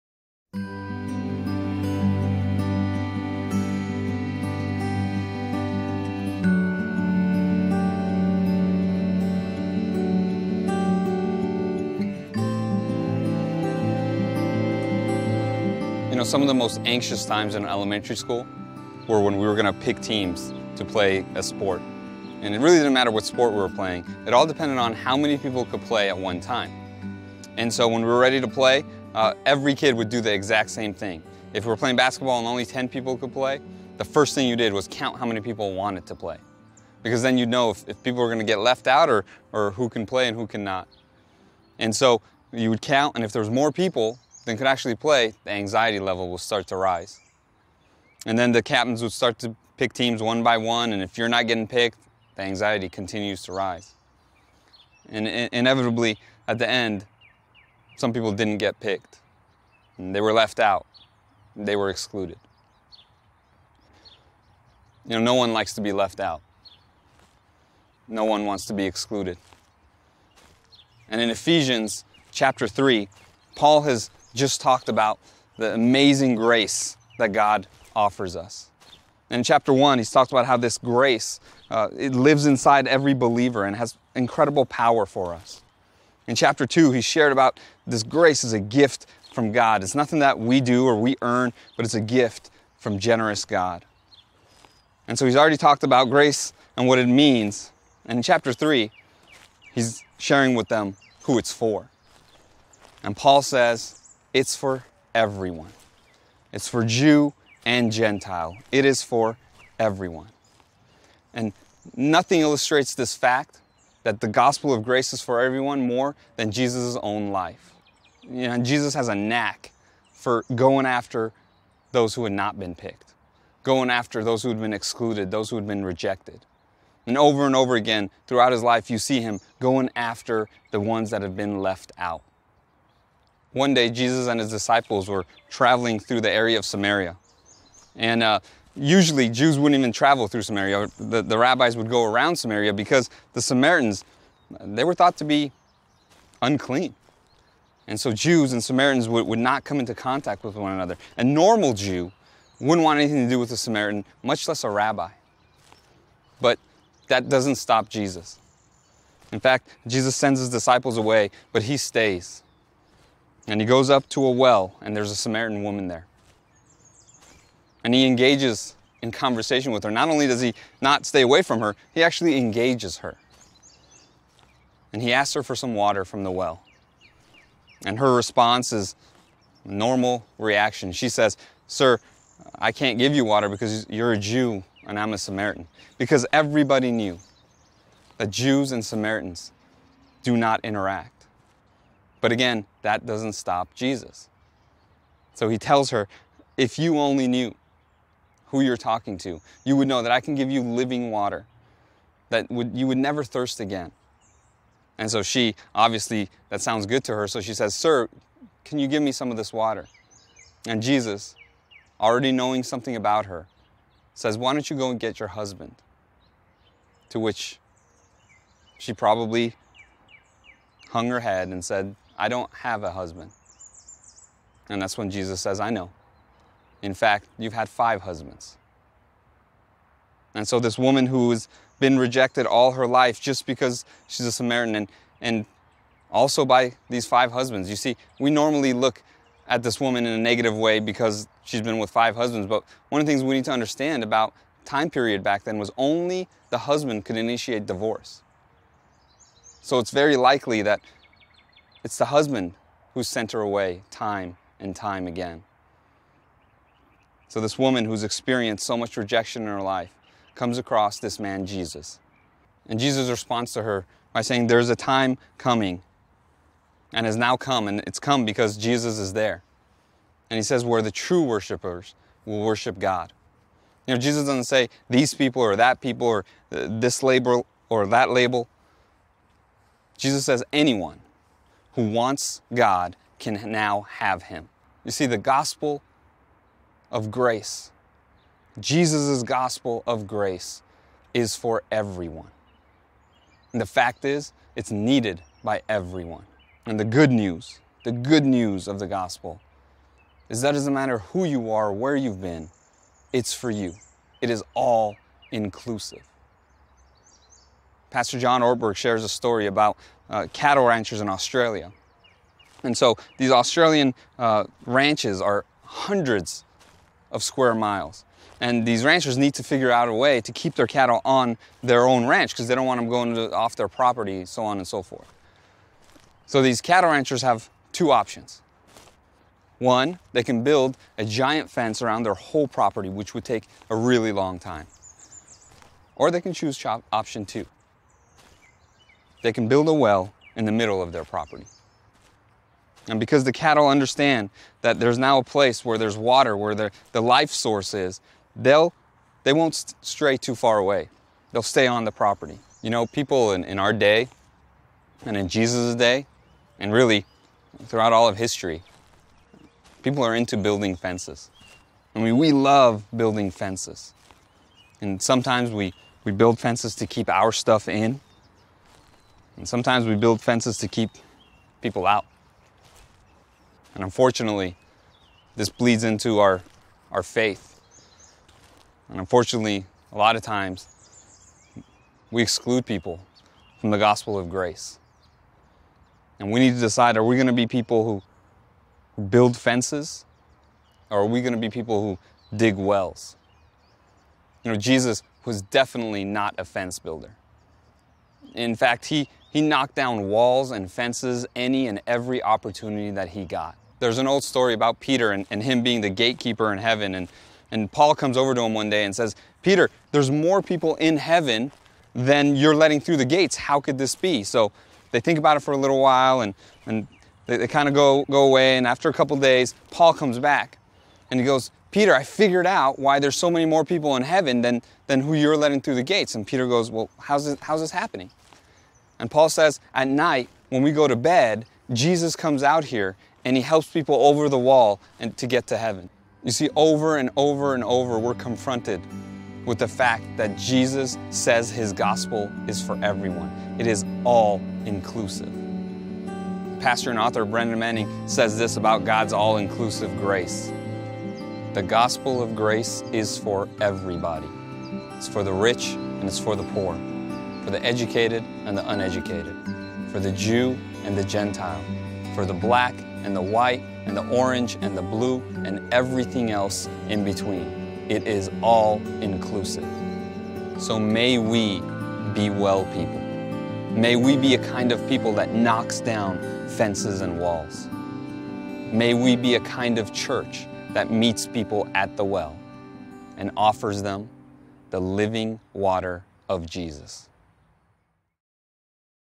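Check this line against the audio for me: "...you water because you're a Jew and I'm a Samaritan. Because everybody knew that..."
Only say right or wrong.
right.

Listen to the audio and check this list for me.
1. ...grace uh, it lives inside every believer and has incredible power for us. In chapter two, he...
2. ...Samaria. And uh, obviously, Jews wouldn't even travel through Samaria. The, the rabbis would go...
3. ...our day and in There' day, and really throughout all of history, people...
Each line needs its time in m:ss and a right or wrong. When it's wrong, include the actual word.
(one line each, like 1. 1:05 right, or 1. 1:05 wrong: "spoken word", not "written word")
1. 1:20 right
2. 2:16 wrong: "usually", not "obviously"
3. 5:53 wrong: "Jesus", not "There".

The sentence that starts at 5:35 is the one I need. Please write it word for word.
Or they can choose option two they can build a well in the middle of their property.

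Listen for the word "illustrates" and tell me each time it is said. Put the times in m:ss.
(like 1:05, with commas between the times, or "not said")
1:52.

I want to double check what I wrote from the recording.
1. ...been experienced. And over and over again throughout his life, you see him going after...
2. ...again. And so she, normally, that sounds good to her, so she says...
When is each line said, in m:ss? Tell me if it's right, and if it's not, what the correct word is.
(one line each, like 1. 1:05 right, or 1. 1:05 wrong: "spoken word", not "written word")
1. 2:05 wrong: "rejected", not "experienced"
2. 3:23 wrong: "obviously", not "normally".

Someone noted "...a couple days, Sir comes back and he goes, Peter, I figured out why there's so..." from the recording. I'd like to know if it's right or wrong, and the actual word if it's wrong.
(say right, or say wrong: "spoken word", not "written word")
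wrong: "Paul", not "Sir".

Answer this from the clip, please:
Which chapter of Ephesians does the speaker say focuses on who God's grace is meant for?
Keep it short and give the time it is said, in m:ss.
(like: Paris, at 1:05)
Chapter 3, at 1:11.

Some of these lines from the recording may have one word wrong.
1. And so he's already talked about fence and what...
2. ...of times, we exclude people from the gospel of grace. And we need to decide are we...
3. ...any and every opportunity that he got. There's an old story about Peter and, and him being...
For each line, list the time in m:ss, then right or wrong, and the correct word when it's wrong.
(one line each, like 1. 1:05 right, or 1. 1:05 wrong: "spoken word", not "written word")
1. 1:35 wrong: "grace", not "fence"
2. 6:20 right
3. 6:41 right.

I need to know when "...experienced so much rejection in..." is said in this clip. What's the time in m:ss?
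4:18.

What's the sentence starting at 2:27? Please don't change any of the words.
And so Jews and Samaritans would, would not come into contact with one another.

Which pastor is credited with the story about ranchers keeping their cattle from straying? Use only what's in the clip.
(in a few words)
John Ortberg.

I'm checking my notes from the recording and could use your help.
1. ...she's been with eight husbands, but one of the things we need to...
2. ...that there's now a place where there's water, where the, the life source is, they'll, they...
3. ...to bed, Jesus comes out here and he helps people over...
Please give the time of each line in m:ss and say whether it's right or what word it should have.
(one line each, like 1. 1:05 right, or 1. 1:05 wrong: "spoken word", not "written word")
1. 4:01 wrong: "five", not "eight"
2. 5:44 right
3. 7:10 right.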